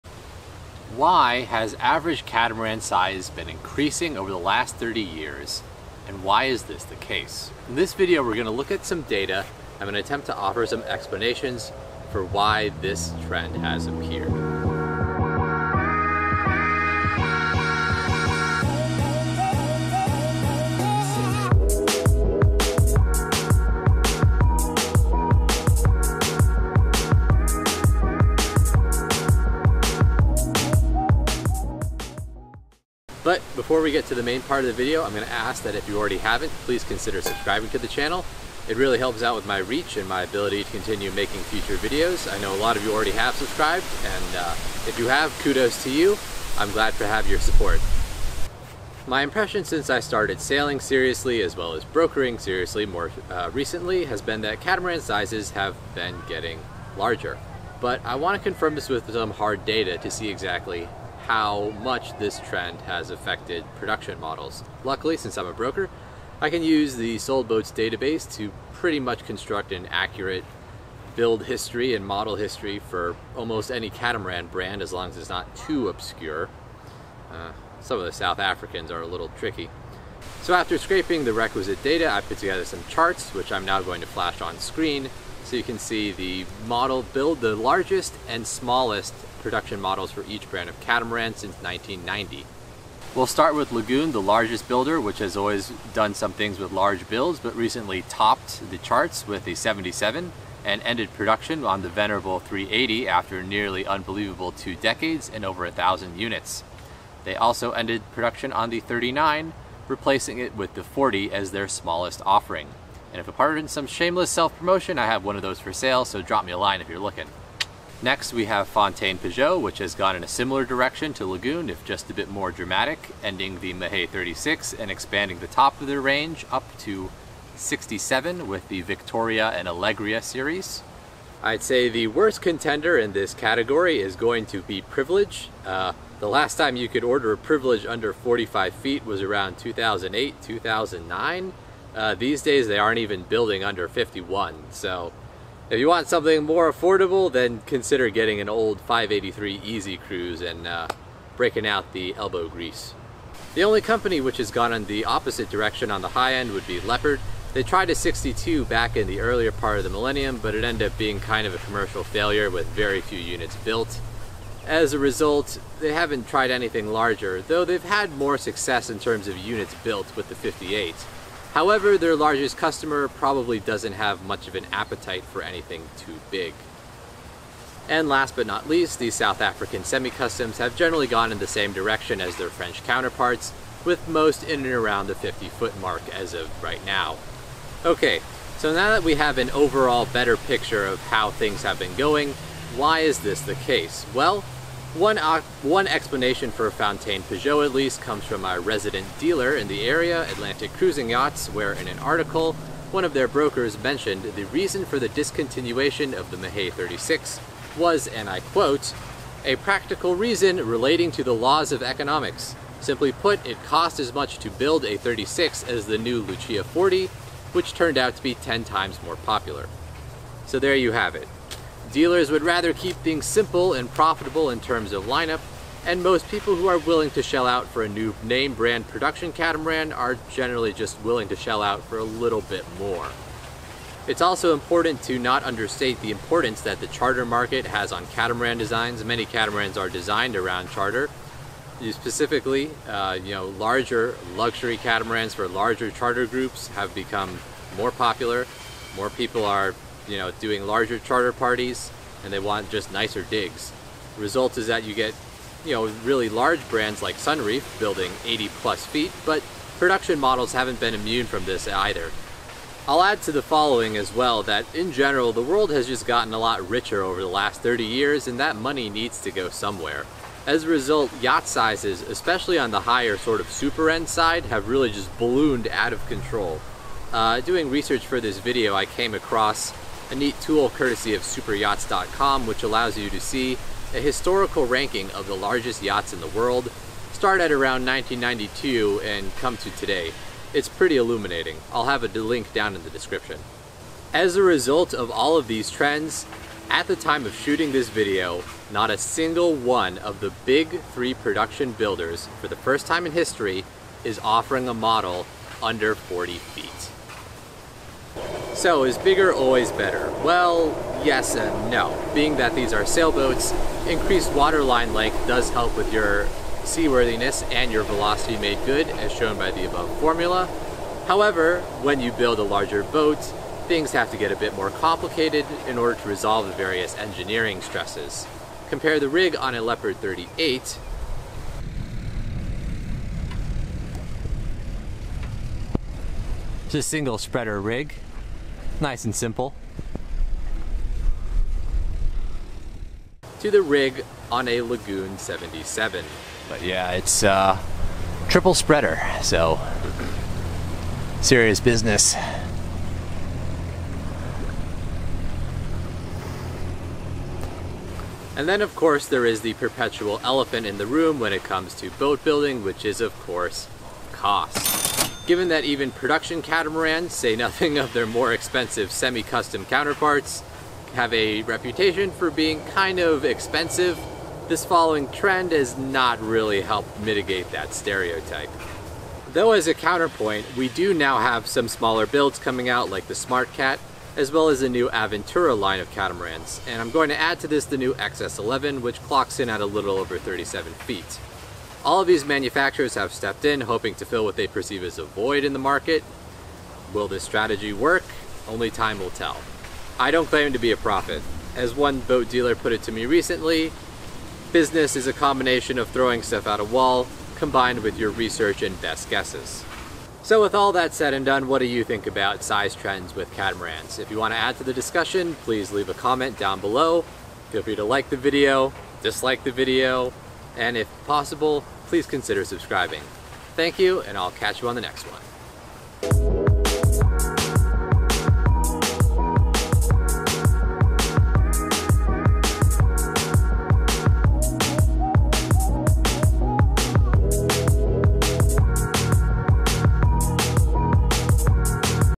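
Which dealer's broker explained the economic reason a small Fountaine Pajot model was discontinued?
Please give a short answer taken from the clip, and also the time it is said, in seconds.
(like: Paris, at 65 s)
Atlantic Cruising Yachts, at 200 s.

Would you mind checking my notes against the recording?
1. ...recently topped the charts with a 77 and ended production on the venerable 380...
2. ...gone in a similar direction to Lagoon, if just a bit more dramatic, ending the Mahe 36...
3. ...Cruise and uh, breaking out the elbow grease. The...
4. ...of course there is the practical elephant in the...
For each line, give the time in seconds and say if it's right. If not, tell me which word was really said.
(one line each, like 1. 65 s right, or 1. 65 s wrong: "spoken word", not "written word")
1. 97 s right
2. 119 s right
3. 149 s right
4. 358 s wrong: "perpetual", not "practical".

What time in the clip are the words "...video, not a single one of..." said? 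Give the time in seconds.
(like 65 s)
297 s.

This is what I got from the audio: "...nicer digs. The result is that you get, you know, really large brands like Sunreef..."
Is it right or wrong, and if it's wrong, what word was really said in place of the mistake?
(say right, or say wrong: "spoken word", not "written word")
right.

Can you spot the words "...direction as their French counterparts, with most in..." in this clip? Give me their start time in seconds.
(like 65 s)
181 s.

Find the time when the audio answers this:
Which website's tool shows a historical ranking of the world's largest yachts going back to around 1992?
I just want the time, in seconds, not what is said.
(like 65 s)
281 s.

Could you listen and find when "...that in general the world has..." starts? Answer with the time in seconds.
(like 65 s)
264 s.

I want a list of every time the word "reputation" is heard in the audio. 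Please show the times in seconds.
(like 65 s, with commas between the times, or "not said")
371 s.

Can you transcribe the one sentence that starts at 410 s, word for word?
So with all that said and done, what do you think about size trends with catamarans?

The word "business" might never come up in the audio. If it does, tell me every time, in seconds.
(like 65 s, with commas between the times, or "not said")
351 s, 404 s.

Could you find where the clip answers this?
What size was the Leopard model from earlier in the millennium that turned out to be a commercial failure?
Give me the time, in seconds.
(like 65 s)
157 s.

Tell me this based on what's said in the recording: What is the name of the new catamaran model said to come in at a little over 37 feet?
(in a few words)
Excess 11.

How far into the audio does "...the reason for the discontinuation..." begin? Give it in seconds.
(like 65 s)
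204 s.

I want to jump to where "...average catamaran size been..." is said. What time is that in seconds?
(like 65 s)
1 s.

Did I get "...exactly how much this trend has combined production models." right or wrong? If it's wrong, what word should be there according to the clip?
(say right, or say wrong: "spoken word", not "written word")
wrong: "affected", not "combined".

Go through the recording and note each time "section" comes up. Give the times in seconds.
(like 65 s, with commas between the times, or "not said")
not said.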